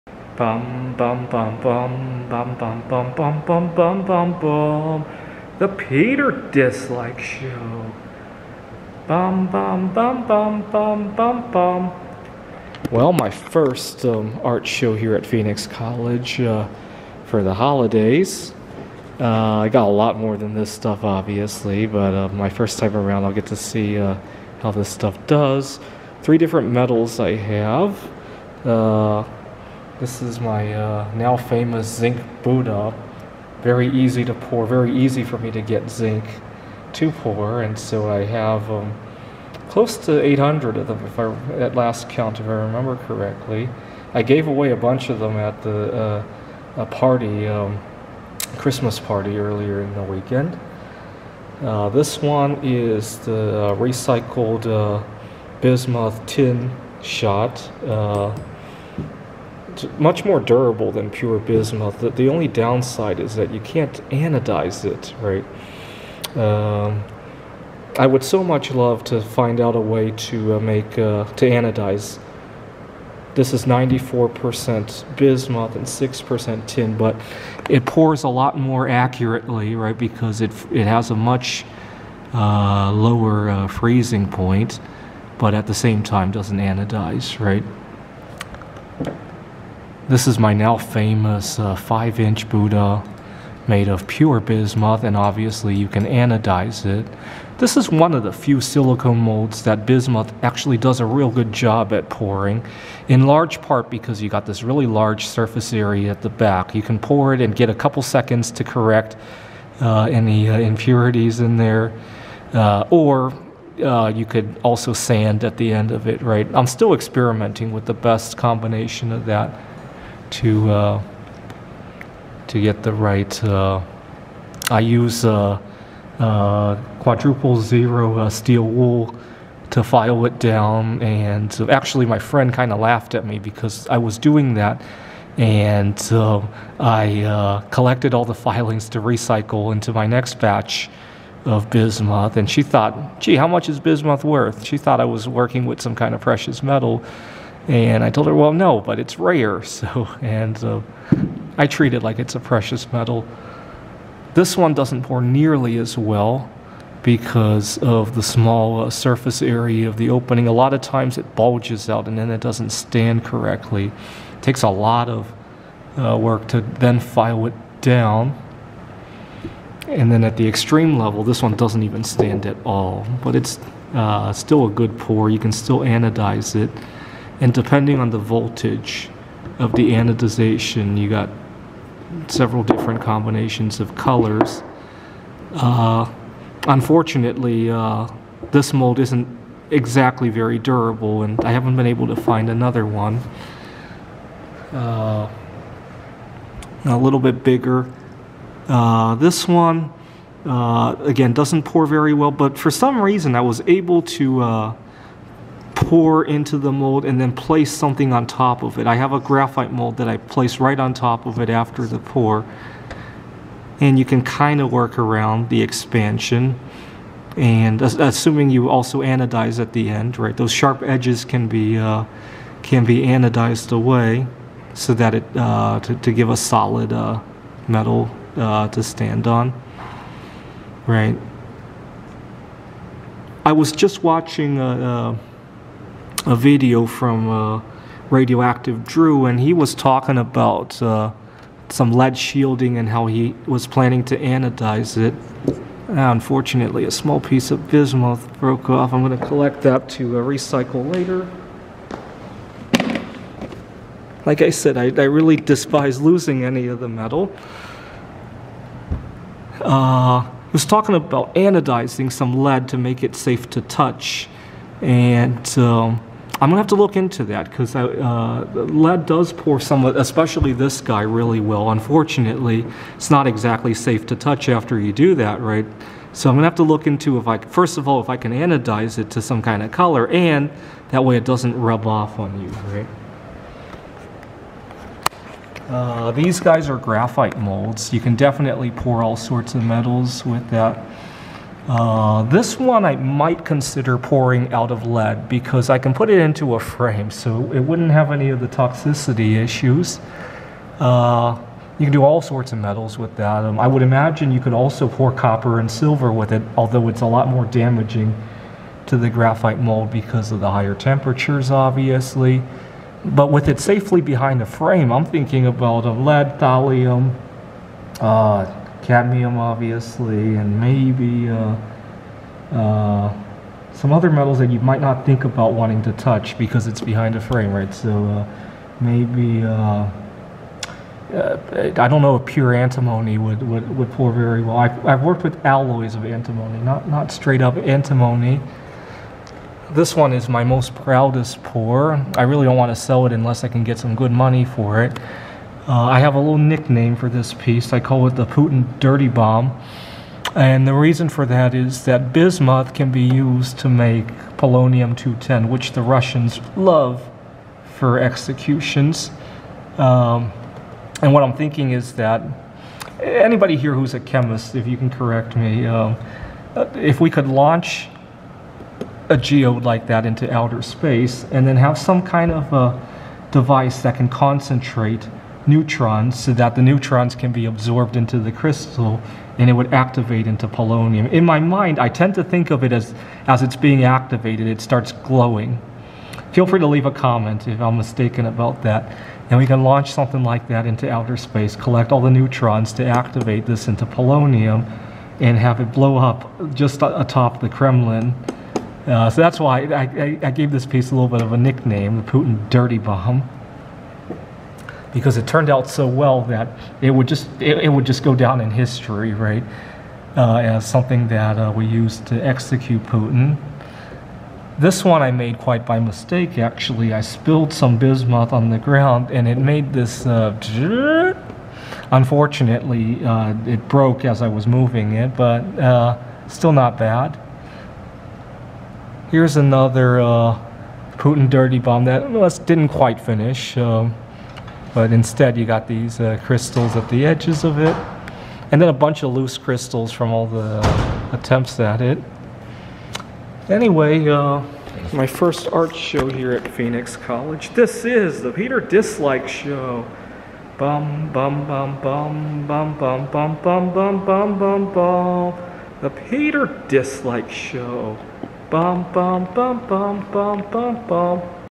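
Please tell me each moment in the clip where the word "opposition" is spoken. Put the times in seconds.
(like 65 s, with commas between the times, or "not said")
not said.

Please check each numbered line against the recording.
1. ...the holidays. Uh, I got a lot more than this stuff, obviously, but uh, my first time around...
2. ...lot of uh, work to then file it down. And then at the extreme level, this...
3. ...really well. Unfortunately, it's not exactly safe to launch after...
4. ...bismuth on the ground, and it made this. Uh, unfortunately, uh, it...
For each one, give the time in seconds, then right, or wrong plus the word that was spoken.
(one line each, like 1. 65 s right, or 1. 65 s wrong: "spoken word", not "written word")
1. 17 s right
2. 164 s right
3. 271 s wrong: "touch", not "launch"
4. 417 s right.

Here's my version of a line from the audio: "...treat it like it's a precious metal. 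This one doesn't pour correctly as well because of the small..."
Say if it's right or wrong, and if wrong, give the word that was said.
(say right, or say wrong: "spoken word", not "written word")
wrong: "nearly", not "correctly".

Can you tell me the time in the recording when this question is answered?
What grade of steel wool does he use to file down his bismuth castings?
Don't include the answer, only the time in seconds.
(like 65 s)
126 s.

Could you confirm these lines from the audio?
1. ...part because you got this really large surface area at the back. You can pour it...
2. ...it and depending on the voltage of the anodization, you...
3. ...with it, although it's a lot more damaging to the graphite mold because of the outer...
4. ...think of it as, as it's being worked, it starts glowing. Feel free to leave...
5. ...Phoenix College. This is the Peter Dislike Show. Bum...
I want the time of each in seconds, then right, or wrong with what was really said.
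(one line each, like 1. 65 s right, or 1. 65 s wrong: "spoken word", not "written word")
1. 103 s right
2. 176 s right
3. 306 s wrong: "higher", not "outer"
4. 382 s wrong: "activated", not "worked"
5. 446 s right.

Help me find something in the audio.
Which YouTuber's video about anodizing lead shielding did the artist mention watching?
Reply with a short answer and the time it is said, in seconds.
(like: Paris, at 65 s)
Radioactive Drew, at 238 s.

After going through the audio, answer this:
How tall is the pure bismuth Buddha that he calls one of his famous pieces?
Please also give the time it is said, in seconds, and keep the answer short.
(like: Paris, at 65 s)
5 inches, at 91 s.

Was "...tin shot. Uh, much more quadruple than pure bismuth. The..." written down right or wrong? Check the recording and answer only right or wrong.
wrong.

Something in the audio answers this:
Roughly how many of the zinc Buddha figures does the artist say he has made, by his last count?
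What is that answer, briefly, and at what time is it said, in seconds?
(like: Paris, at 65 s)
800, at 40 s.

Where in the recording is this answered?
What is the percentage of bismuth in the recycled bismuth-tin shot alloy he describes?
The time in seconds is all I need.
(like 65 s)
73 s.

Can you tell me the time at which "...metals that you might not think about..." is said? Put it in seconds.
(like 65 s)
324 s.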